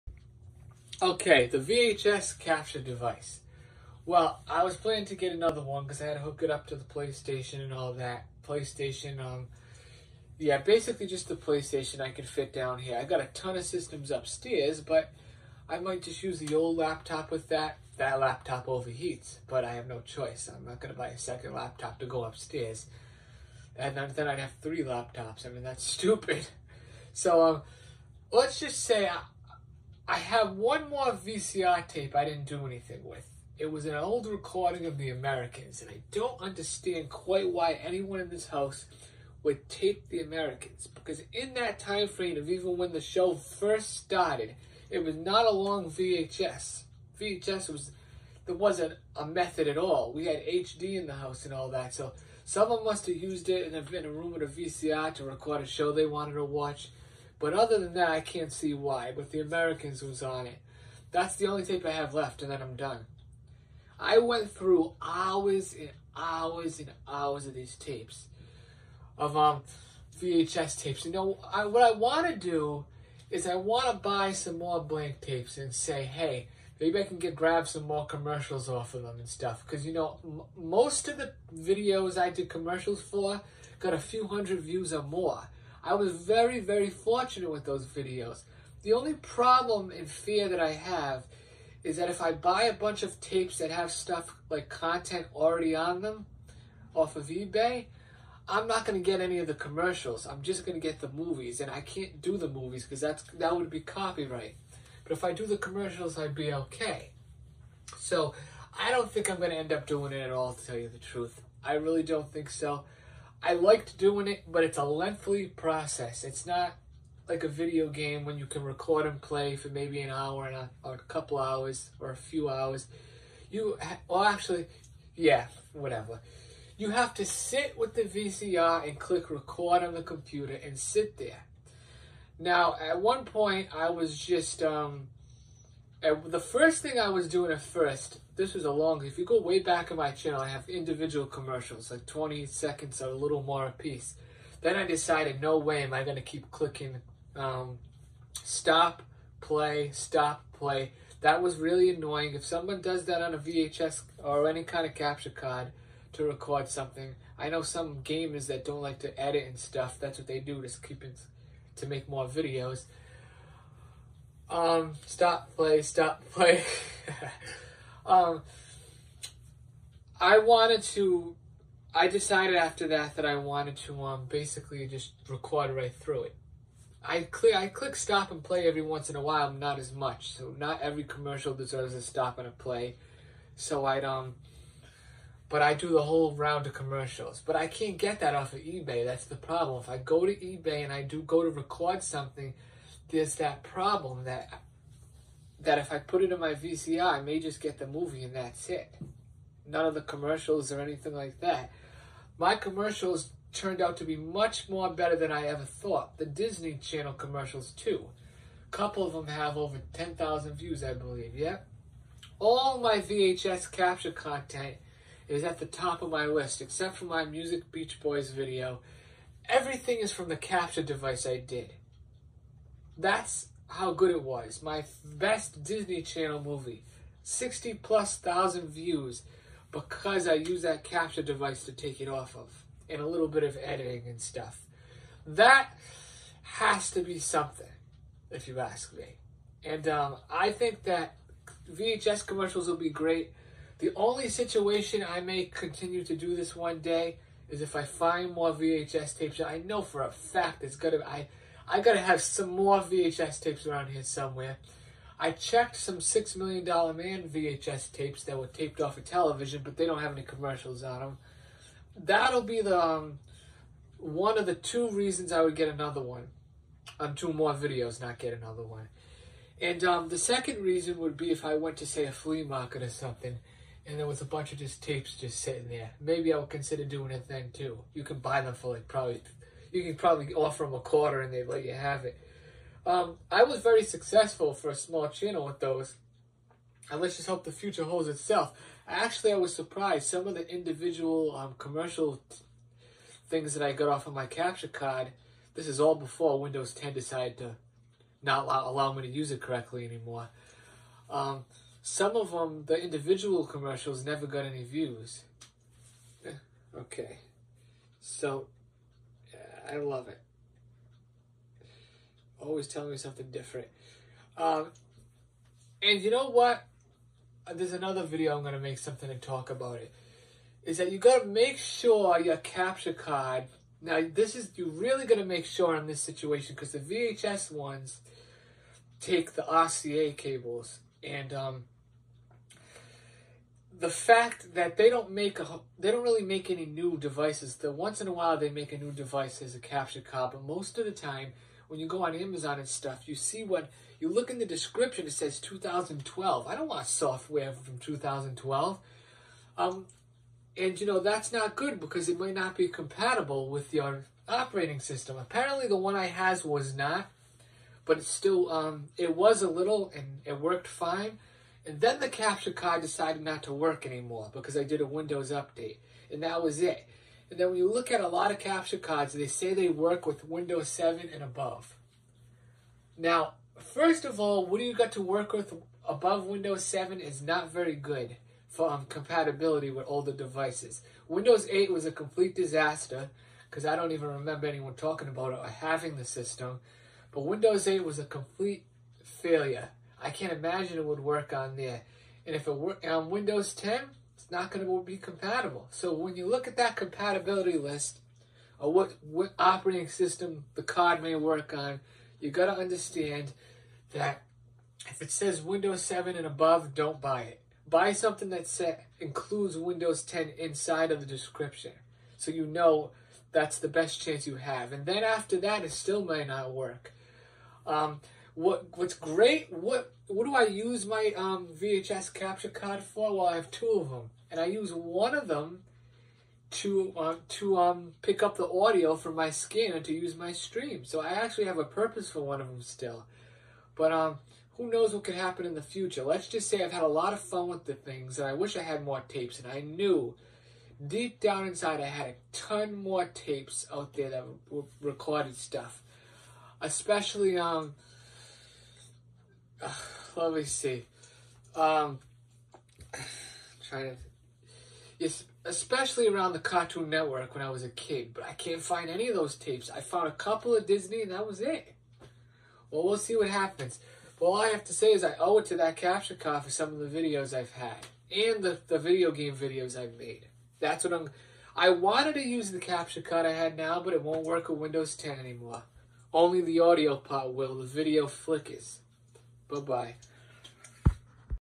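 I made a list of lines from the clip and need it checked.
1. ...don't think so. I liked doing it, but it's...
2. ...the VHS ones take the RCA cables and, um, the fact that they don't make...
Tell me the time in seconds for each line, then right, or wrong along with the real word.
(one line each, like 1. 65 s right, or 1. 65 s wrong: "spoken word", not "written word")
1. 112 s right
2. 326 s right.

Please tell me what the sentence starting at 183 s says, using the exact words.
So I'd um, but I do the whole round of commercials.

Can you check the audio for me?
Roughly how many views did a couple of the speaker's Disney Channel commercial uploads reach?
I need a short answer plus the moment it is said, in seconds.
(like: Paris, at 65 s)
over 10,000, at 209 s.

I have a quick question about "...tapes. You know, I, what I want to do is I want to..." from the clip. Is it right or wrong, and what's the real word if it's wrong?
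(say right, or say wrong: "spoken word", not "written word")
right.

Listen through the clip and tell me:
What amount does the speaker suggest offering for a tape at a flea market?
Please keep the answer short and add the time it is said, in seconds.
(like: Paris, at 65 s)
a quarter, at 280 s.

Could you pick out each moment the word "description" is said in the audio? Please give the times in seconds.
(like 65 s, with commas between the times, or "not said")
344 s, 411 s.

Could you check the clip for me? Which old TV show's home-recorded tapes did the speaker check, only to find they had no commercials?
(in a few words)
Six Million Dollar Man.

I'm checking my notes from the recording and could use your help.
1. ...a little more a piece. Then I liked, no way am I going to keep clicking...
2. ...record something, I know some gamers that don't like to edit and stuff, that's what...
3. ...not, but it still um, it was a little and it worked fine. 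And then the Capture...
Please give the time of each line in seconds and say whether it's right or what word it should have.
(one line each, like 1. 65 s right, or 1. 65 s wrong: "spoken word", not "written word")
1. 143 s wrong: "decided", not "liked"
2. 156 s right
3. 356 s right.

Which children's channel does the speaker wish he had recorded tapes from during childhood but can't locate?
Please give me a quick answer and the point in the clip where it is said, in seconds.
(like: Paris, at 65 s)
Cartoon Network, at 456 s.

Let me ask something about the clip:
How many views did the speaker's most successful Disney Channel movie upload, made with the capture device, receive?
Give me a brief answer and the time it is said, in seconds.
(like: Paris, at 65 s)
60 plus thousand, at 227 s.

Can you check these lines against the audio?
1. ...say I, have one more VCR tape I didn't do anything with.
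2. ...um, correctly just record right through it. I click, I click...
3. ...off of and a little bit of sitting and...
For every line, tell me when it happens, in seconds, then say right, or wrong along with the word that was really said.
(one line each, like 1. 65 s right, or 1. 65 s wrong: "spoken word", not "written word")
1. 28 s right
2. 174 s wrong: "basically", not "correctly"
3. 232 s wrong: "editing", not "sitting".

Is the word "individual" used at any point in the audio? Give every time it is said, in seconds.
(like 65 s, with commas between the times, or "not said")
140 s, 290 s, 302 s.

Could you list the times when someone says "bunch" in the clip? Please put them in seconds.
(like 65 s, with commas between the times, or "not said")
92 s, 274 s.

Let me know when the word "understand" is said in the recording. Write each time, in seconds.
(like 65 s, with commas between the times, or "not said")
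36 s, 402 s.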